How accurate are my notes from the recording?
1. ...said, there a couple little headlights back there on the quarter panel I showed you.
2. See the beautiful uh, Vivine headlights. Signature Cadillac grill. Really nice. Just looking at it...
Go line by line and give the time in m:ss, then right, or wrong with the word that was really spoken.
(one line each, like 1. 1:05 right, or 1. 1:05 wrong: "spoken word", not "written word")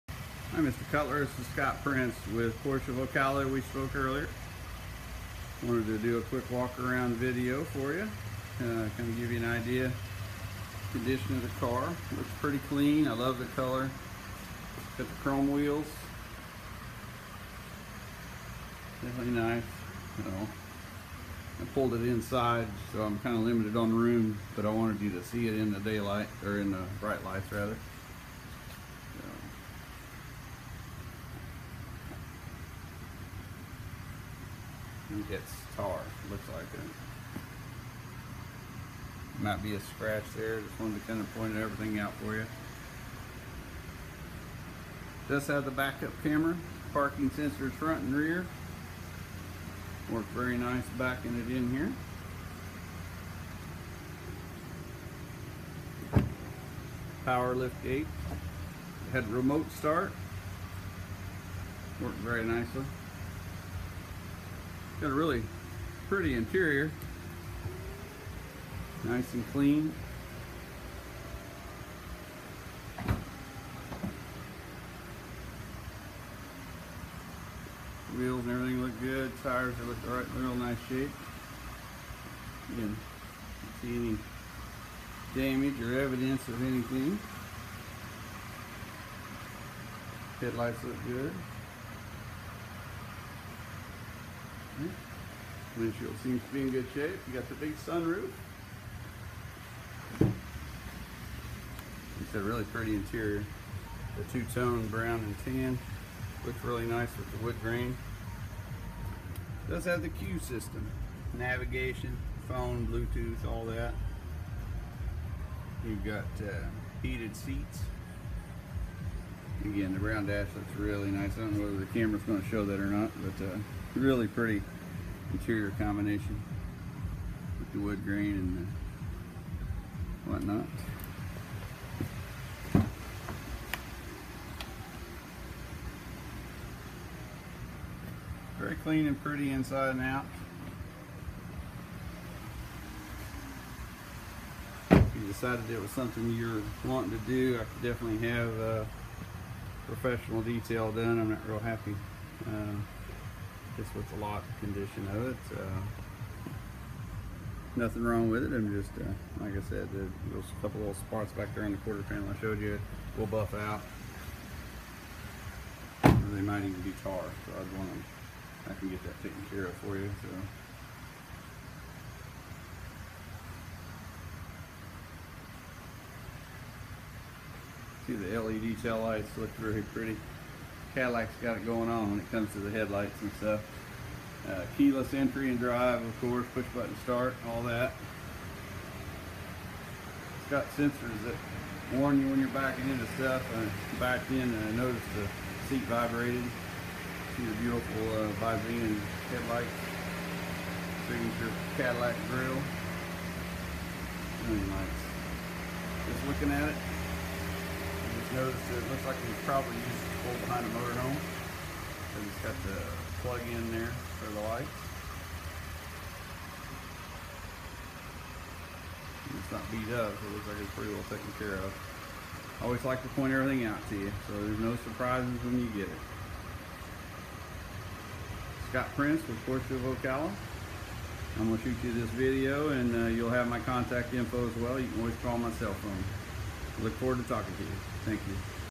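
1. 2:39 wrong: "spots", not "headlights"
2. 3:17 right.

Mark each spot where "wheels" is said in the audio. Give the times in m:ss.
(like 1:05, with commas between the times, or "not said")
0:15, 1:18.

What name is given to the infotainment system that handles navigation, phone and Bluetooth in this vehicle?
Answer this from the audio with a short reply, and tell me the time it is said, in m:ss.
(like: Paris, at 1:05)
CUE, at 1:50.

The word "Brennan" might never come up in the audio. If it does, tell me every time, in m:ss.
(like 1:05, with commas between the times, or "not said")
not said.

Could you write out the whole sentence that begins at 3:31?
Because it's got the plug in there for the lights.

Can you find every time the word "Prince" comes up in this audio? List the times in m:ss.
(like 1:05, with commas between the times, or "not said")
0:01, 3:48.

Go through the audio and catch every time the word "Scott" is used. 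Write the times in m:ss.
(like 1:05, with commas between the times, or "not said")
0:01, 3:48.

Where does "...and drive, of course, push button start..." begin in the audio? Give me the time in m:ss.
3:05.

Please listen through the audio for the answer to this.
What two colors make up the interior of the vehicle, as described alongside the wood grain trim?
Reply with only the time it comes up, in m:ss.
1:44.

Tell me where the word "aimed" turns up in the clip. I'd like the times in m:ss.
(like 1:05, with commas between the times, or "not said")
not said.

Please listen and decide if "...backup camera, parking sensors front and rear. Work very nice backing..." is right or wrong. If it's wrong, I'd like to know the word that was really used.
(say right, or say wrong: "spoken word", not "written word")
right.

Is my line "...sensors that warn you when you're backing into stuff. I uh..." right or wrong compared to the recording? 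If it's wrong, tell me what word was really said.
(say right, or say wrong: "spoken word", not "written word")
right.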